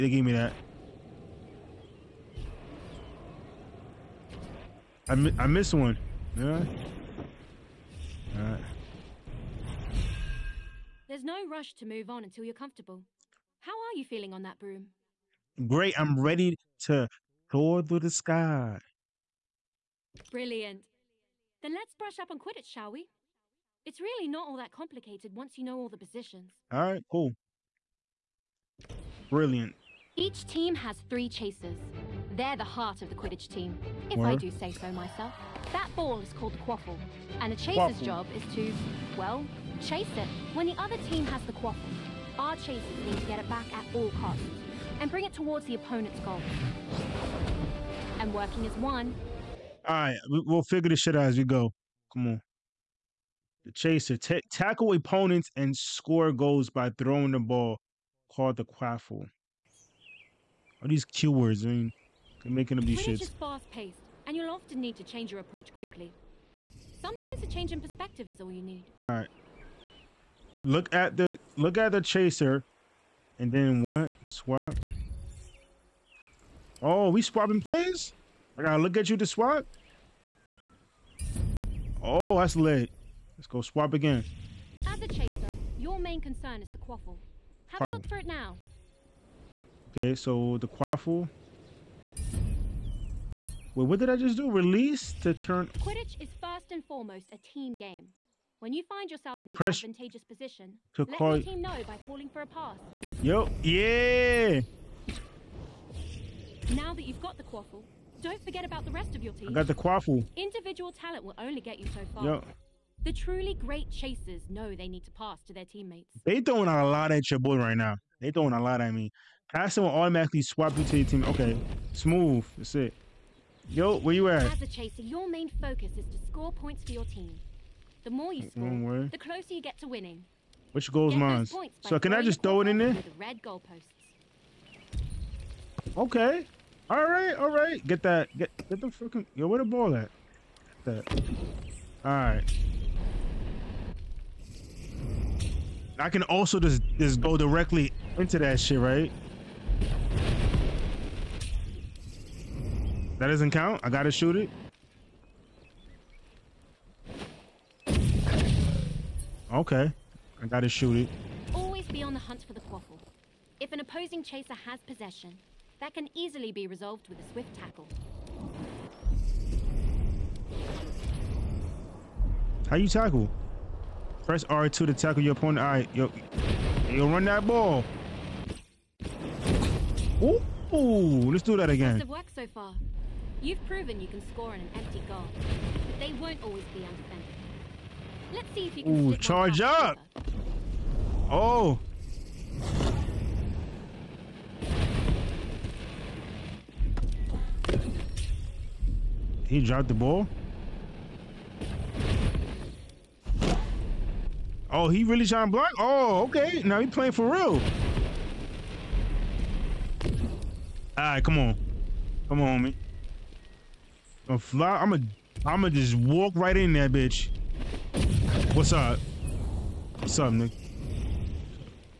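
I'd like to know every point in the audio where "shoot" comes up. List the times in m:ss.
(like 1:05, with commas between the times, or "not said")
2:34, 2:40.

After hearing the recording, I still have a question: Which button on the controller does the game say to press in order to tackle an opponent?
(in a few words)
R2.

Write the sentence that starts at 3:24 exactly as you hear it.
Oh, he really trying to block?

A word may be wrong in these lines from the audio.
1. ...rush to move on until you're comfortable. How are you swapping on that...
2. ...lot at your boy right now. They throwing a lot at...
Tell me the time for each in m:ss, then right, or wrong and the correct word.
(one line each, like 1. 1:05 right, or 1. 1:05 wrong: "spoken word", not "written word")
1. 0:11 wrong: "feeling", not "swapping"
2. 1:56 right.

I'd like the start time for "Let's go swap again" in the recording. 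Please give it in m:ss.
1:23.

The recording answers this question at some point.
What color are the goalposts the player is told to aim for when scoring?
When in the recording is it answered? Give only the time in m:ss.
2:13.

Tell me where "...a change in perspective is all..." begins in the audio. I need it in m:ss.
1:07.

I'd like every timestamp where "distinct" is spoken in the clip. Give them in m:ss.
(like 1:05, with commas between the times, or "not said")
not said.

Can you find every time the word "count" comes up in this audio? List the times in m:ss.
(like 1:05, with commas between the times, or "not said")
2:33.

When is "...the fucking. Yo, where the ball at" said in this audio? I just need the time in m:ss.
2:18.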